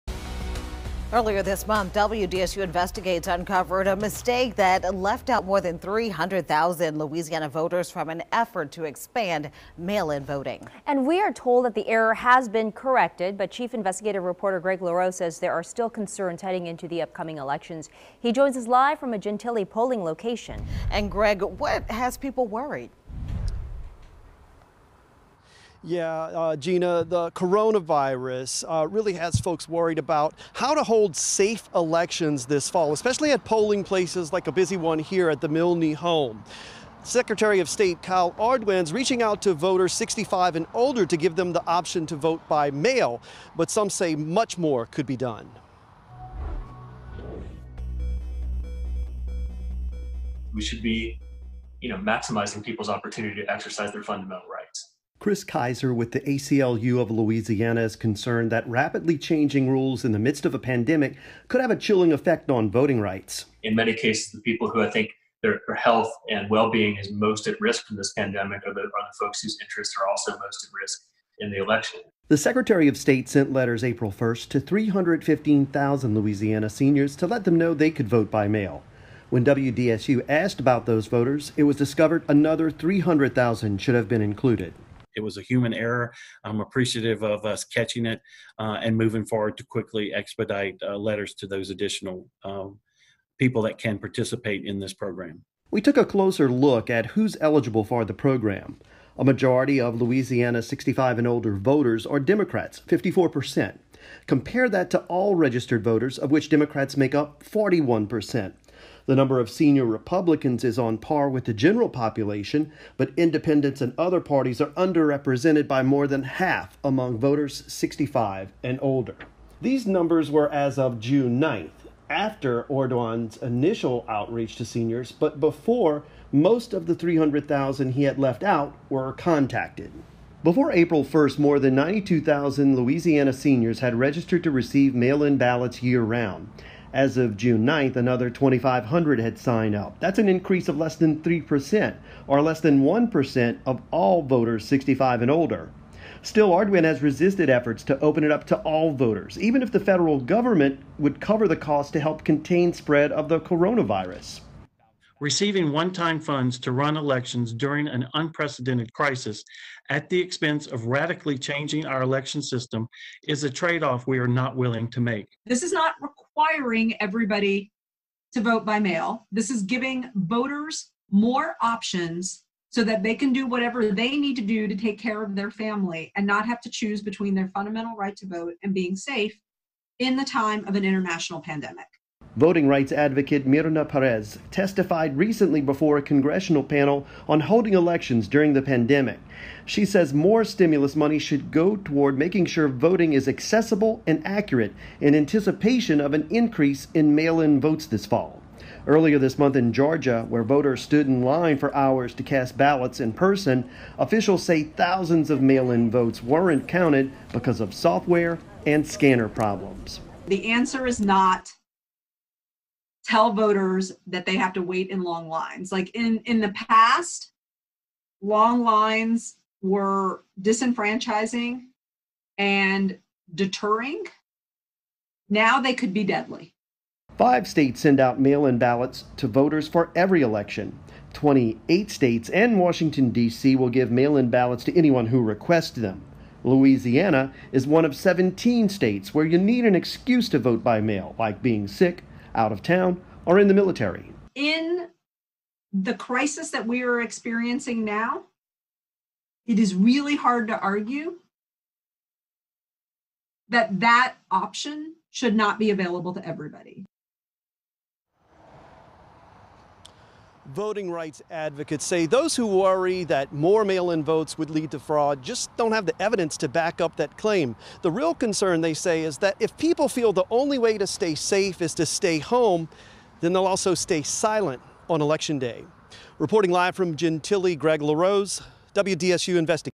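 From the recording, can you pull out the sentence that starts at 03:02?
Voting rights advocate Myrna Perez testified recently before a congressional panel on holding elections during the pandemic.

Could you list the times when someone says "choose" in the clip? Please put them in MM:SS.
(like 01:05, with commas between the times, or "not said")
02:56.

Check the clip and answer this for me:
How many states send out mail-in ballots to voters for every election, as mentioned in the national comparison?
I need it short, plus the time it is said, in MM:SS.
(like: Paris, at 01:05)
5, at 03:47.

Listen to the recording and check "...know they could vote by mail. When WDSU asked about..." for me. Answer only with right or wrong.
right.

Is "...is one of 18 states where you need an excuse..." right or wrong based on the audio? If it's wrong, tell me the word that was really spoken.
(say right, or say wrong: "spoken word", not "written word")
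wrong: "17", not "18".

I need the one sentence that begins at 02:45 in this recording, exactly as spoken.
This is not requiring everybody to vote by mail.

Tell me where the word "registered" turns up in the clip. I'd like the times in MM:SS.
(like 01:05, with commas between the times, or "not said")
01:45, 02:13.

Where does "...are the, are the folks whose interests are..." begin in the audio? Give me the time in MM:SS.
01:08.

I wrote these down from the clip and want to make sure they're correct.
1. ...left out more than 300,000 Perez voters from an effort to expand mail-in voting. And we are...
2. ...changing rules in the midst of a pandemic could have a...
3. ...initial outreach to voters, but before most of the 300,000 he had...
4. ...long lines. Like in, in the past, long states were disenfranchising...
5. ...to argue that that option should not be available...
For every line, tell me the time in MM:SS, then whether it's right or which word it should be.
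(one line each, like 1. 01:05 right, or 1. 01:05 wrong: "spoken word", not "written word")
1. 00:04 wrong: "Louisiana", not "Perez"
2. 00:59 right
3. 02:03 wrong: "seniors", not "voters"
4. 03:35 wrong: "lines", not "states"
5. 04:10 right.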